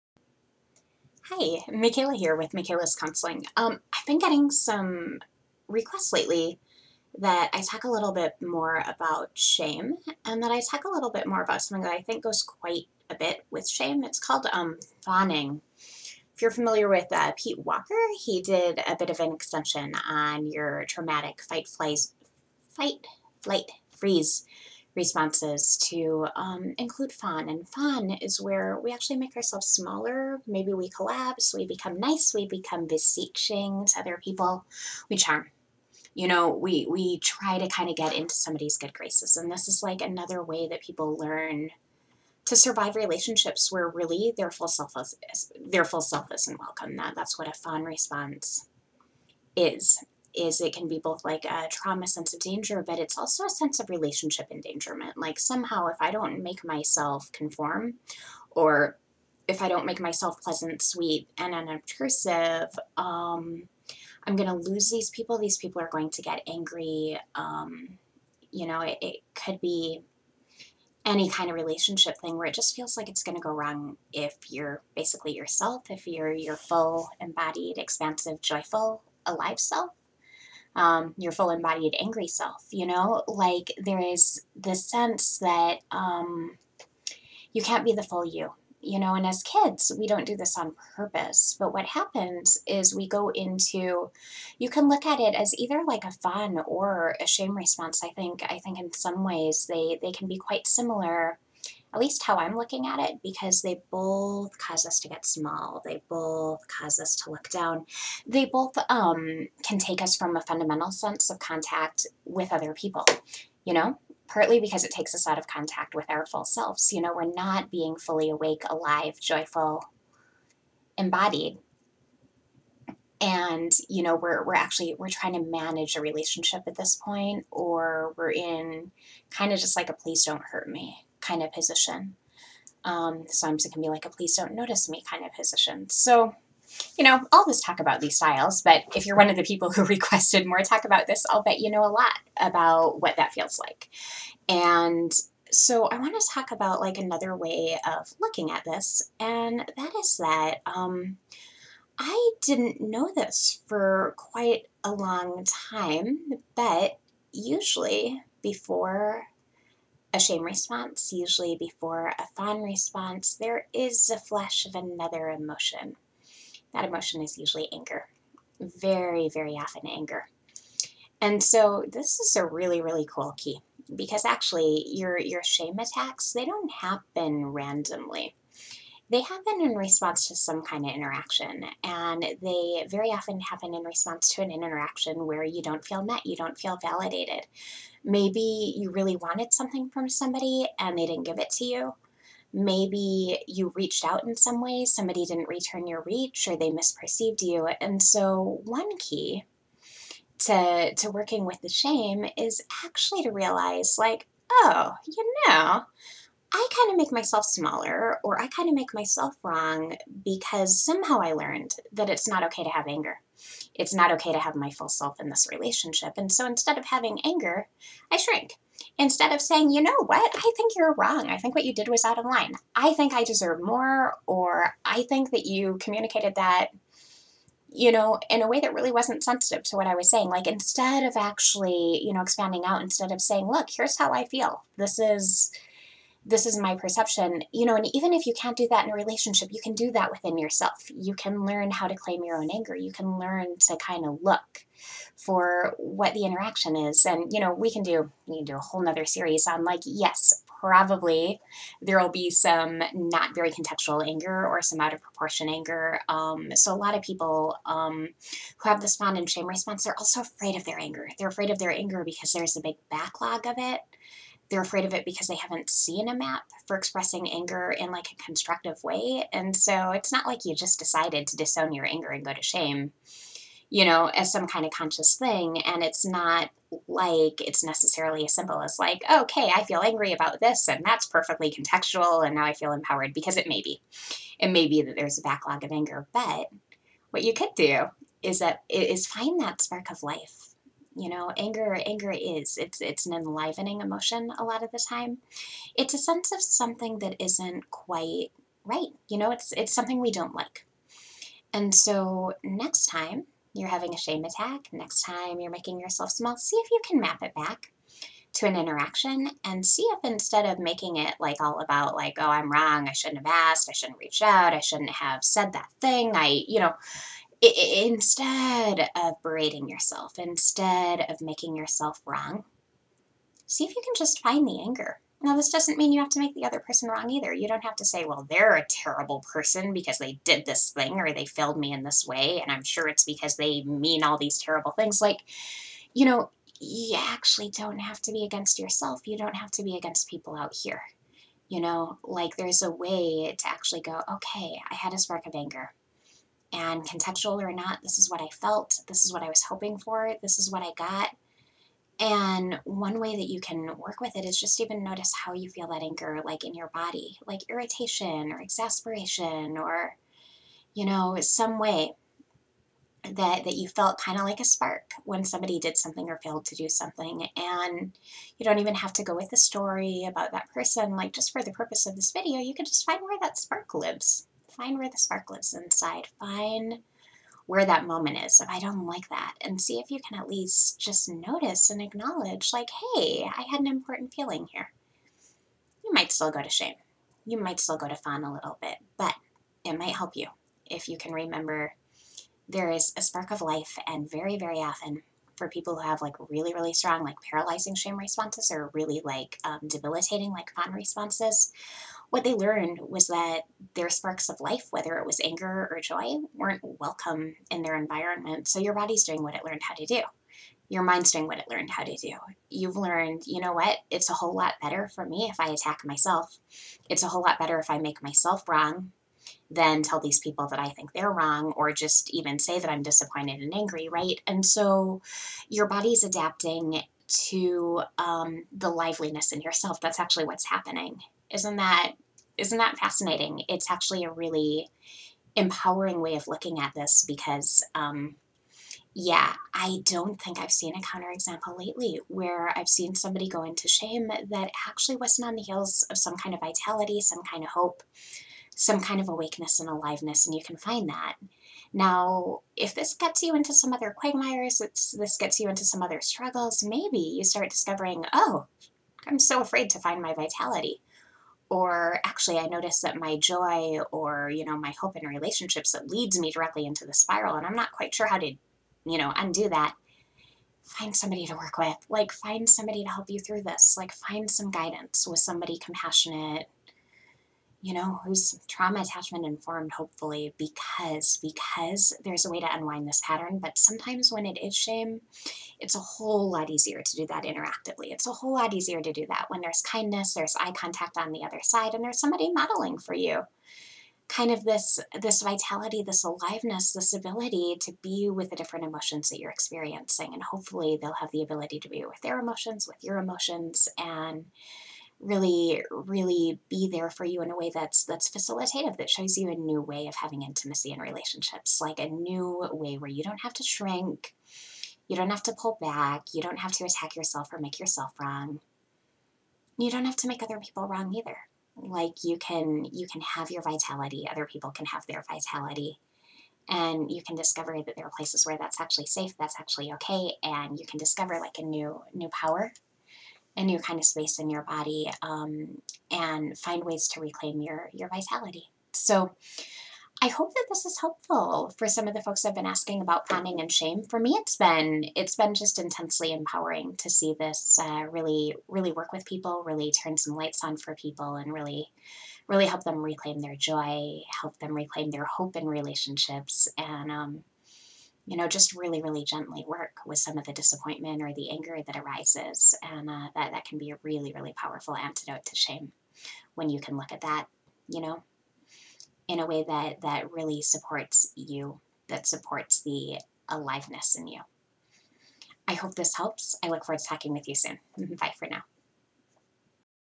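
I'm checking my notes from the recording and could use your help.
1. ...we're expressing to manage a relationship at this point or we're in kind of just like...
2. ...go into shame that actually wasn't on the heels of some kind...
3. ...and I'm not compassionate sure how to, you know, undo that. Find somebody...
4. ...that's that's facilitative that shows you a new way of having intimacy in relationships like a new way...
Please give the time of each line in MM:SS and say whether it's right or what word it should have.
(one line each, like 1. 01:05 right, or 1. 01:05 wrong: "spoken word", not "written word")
1. 02:04 wrong: "trying", not "expressing"
2. 07:23 right
3. 07:47 wrong: "quite", not "compassionate"
4. 08:27 right.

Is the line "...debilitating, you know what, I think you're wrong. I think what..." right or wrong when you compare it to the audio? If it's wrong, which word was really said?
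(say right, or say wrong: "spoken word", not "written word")
wrong: "saying", not "debilitating".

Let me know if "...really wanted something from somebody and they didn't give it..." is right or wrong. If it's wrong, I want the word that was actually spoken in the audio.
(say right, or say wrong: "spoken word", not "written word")
right.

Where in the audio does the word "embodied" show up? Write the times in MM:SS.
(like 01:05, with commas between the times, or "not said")
01:17, 01:21, 02:00.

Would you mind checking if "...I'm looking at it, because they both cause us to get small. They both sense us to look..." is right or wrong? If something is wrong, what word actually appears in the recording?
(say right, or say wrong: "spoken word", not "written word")
wrong: "cause", not "sense".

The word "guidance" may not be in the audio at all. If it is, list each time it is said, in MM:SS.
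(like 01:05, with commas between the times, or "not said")
07:54.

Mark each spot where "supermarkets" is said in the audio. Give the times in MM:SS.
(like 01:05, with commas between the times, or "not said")
not said.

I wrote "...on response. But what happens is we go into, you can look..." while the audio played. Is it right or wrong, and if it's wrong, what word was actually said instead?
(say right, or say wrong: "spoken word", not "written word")
wrong: "purpose", not "response".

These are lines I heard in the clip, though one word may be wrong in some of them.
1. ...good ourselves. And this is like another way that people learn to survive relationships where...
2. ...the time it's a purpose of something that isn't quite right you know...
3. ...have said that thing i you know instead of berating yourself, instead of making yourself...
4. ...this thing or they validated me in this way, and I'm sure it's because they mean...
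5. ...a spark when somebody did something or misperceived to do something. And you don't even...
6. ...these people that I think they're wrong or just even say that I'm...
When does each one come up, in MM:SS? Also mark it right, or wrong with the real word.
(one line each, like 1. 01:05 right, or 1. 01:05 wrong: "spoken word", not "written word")
1. 00:38 wrong: "graces", not "ourselves"
2. 04:54 wrong: "sense", not "purpose"
3. 05:14 right
4. 05:30 wrong: "failed", not "validated"
5. 06:04 wrong: "failed", not "misperceived"
6. 07:00 right.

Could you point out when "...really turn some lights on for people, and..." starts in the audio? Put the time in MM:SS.
09:09.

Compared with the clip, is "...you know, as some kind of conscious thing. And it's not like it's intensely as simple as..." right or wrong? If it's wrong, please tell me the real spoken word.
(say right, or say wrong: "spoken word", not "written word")
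wrong: "necessarily", not "intensely".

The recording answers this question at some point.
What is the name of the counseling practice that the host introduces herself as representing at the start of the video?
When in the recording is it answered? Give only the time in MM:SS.
00:02.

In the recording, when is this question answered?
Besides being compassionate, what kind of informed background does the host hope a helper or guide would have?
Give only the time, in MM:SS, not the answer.
07:58.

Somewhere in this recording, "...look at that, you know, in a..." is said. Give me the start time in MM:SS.
09:26.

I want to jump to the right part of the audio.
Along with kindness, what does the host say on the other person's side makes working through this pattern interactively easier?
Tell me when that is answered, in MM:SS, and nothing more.
08:10.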